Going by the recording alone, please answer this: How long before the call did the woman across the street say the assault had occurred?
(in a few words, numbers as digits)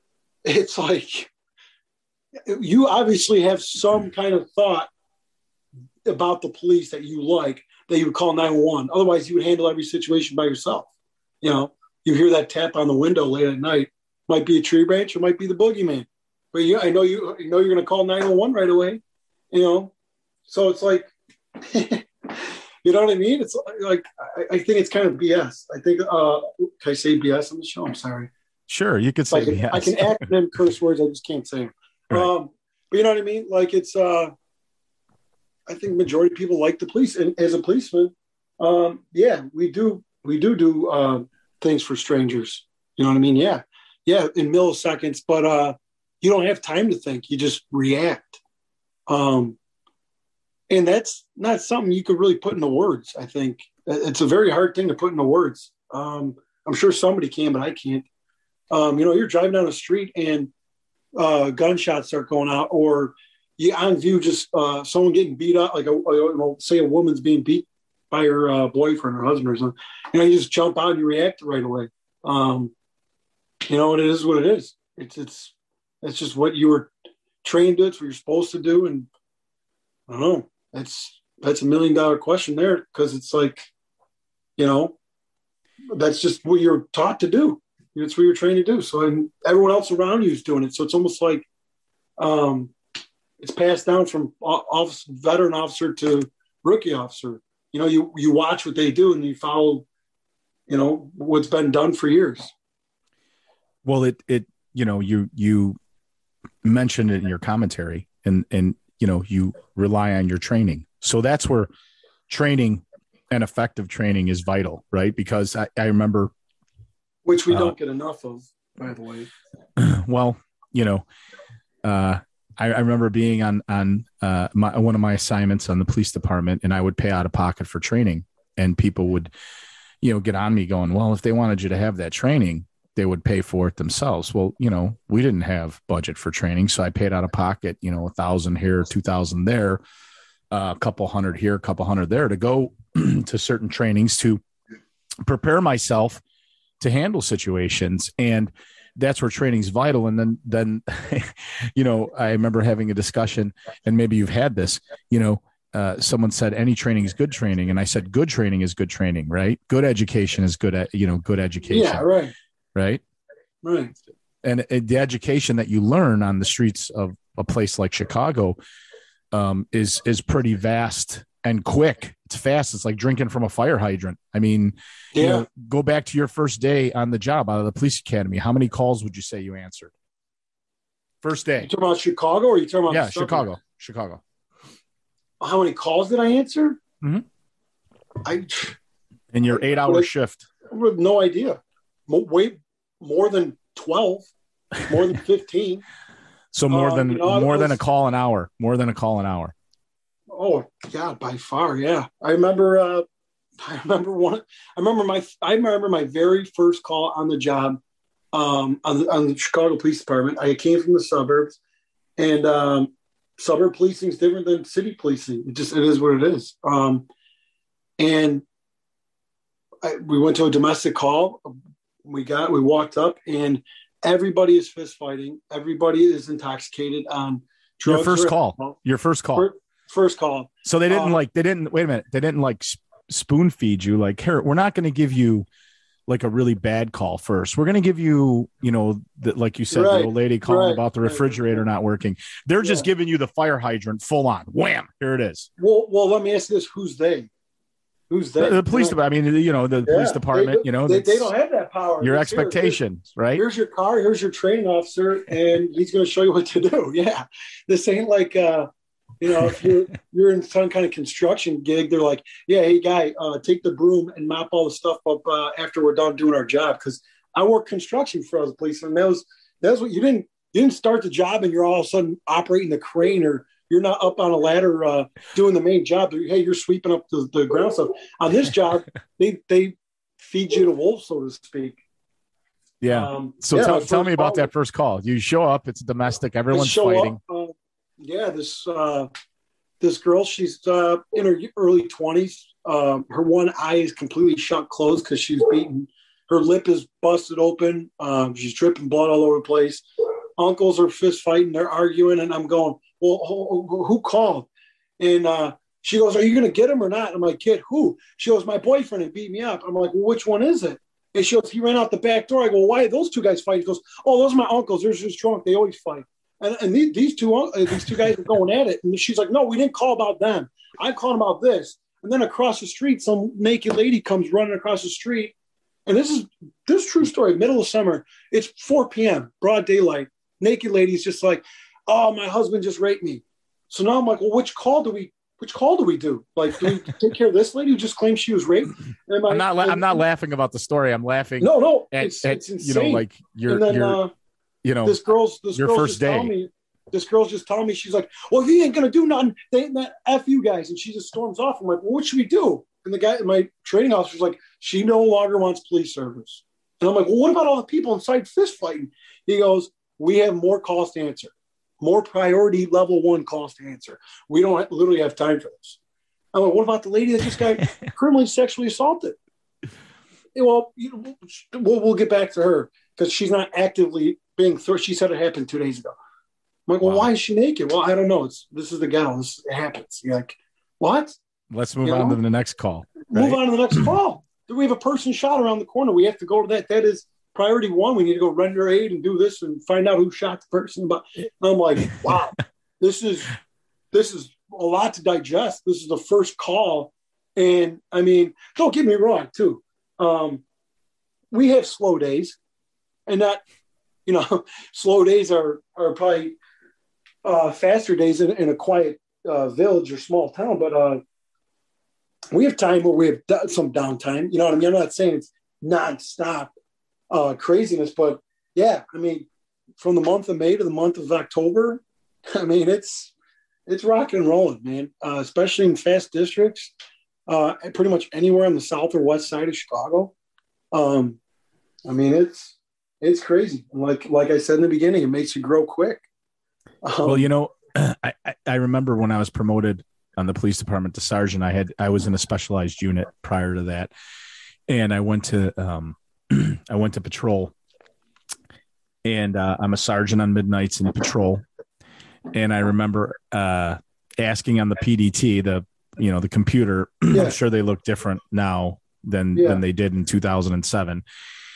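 two days ago.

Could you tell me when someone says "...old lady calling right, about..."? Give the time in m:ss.
4:00.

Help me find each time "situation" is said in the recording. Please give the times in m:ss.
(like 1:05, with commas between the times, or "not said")
0:09, 2:27.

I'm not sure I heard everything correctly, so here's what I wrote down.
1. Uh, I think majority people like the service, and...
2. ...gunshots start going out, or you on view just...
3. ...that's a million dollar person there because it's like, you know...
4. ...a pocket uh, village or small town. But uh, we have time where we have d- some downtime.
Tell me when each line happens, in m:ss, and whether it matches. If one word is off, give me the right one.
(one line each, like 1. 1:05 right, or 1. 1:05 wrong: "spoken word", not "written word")
1. 0:33 wrong: "police", not "service"
2. 1:01 right
3. 1:21 wrong: "question", not "person"
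4. 6:48 wrong: "quiet", not "pocket".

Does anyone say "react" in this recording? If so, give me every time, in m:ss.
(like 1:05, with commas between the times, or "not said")
0:47, 1:11.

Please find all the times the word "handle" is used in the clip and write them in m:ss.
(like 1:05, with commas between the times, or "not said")
0:09, 2:26.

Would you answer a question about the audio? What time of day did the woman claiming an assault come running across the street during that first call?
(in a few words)
4 p.m.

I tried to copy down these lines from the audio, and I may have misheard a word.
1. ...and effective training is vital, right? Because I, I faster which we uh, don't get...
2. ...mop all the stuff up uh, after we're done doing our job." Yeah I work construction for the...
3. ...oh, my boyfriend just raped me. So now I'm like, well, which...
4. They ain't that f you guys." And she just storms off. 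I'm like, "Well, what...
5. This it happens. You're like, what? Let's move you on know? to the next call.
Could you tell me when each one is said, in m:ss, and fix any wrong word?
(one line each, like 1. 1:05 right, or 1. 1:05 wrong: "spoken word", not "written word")
1. 1:53 wrong: "remember", not "faster"
2. 4:24 wrong: "Because", not "Yeah"
3. 5:31 wrong: "husband", not "boyfriend"
4. 5:49 right
5. 6:19 right.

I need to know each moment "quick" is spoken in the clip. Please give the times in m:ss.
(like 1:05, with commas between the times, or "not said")
2:51, 7:15.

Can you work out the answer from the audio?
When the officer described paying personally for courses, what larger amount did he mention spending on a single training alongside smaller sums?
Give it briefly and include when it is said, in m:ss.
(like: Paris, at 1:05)
2,000, at 2:18.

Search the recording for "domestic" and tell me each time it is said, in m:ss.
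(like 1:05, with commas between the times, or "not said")
3:40, 4:45.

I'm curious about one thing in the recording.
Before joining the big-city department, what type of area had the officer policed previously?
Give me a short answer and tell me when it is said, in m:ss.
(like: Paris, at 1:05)
the suburbs, at 3:30.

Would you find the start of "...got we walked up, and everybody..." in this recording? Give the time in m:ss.
3:42.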